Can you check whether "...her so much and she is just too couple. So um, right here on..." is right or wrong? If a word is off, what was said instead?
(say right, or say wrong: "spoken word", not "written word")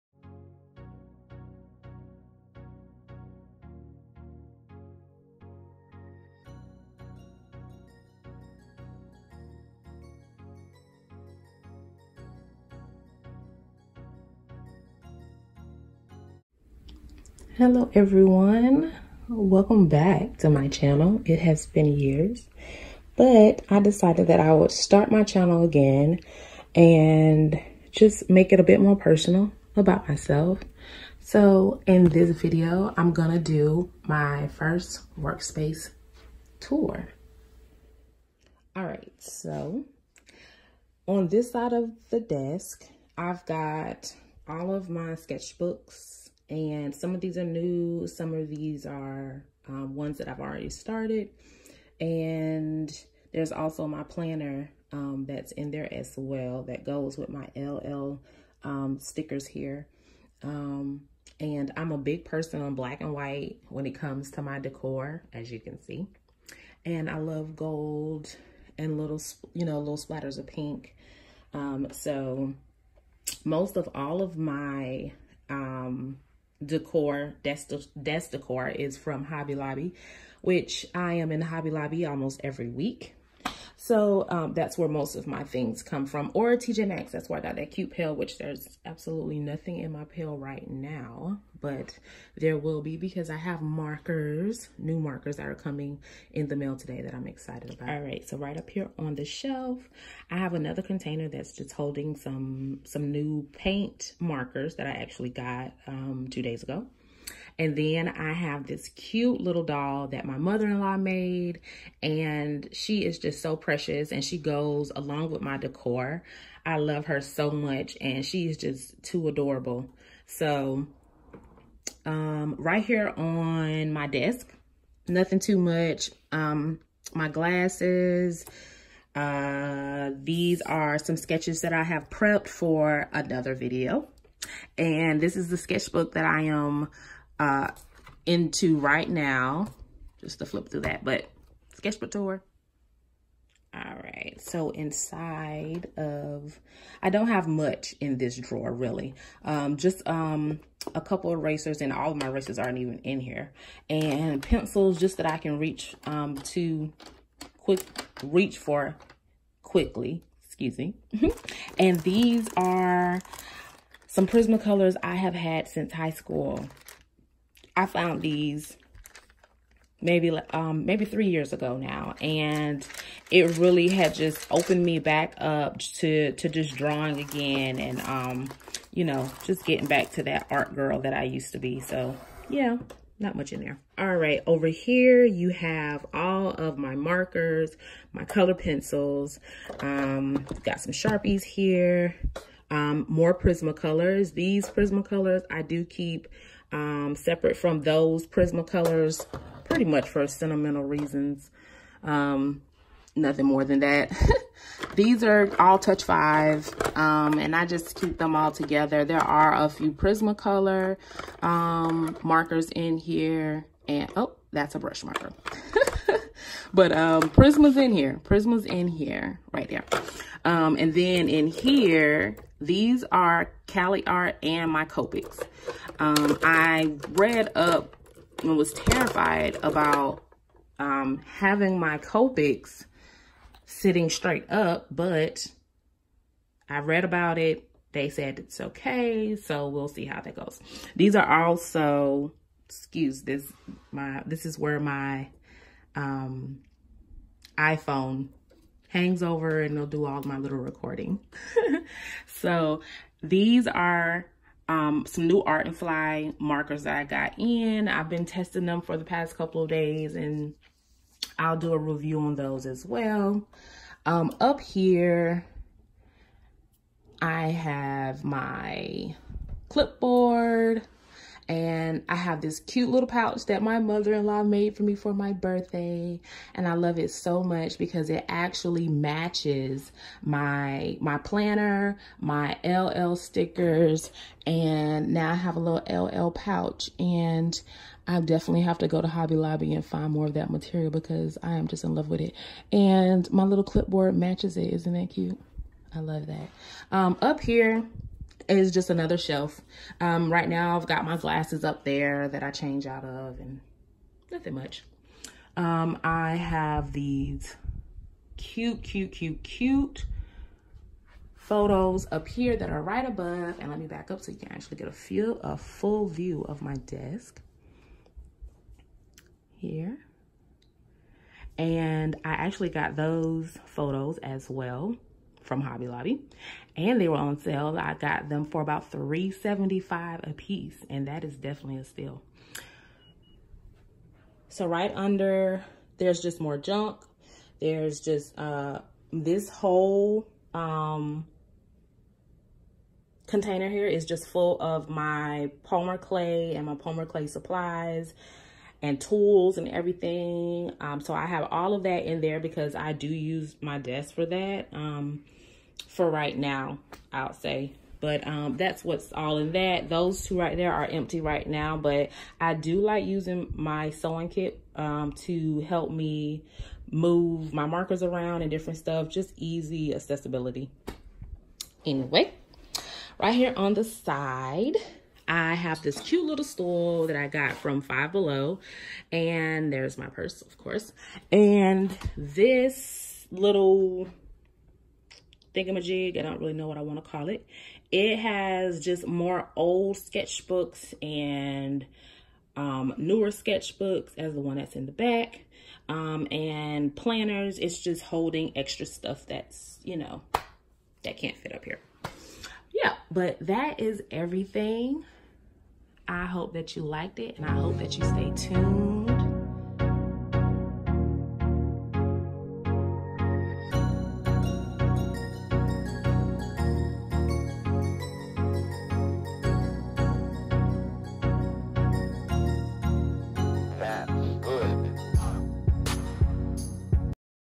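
wrong: "adorable", not "couple".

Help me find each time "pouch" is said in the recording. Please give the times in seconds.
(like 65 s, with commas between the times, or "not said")
273 s, 286 s.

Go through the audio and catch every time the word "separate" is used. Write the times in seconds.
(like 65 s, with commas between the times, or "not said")
197 s.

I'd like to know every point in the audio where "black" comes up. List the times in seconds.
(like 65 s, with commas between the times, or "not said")
62 s.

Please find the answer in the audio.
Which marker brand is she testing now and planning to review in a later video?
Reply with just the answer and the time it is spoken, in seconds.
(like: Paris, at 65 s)
Art and Fly, at 255 s.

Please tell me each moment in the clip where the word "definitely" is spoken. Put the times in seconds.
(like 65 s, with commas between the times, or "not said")
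288 s, 331 s.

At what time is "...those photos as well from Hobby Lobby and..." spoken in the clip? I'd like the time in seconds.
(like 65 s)
322 s.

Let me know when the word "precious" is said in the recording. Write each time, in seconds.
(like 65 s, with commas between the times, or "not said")
113 s.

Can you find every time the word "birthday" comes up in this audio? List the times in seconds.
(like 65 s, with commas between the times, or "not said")
275 s.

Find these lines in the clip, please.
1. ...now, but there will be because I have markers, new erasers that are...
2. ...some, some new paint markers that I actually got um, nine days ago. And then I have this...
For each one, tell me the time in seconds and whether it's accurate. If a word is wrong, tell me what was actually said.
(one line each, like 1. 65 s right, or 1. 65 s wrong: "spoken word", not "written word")
1. 90 s wrong: "markers", not "erasers"
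2. 102 s wrong: "two", not "nine".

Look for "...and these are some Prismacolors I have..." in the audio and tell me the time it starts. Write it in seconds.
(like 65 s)
161 s.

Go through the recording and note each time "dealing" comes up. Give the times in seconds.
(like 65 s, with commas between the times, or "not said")
not said.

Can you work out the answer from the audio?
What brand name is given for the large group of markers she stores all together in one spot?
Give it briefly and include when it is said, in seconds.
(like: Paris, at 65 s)
Touch 5, at 205 s.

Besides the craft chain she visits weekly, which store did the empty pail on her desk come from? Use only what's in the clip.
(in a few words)
TJ Maxx.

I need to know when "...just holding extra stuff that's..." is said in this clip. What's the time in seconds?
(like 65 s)
397 s.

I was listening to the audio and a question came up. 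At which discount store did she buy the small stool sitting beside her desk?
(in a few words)
Five Below.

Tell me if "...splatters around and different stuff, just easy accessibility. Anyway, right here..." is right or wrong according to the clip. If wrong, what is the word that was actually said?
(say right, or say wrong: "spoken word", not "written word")
wrong: "markers", not "splatters".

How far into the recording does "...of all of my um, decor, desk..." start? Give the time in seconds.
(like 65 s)
73 s.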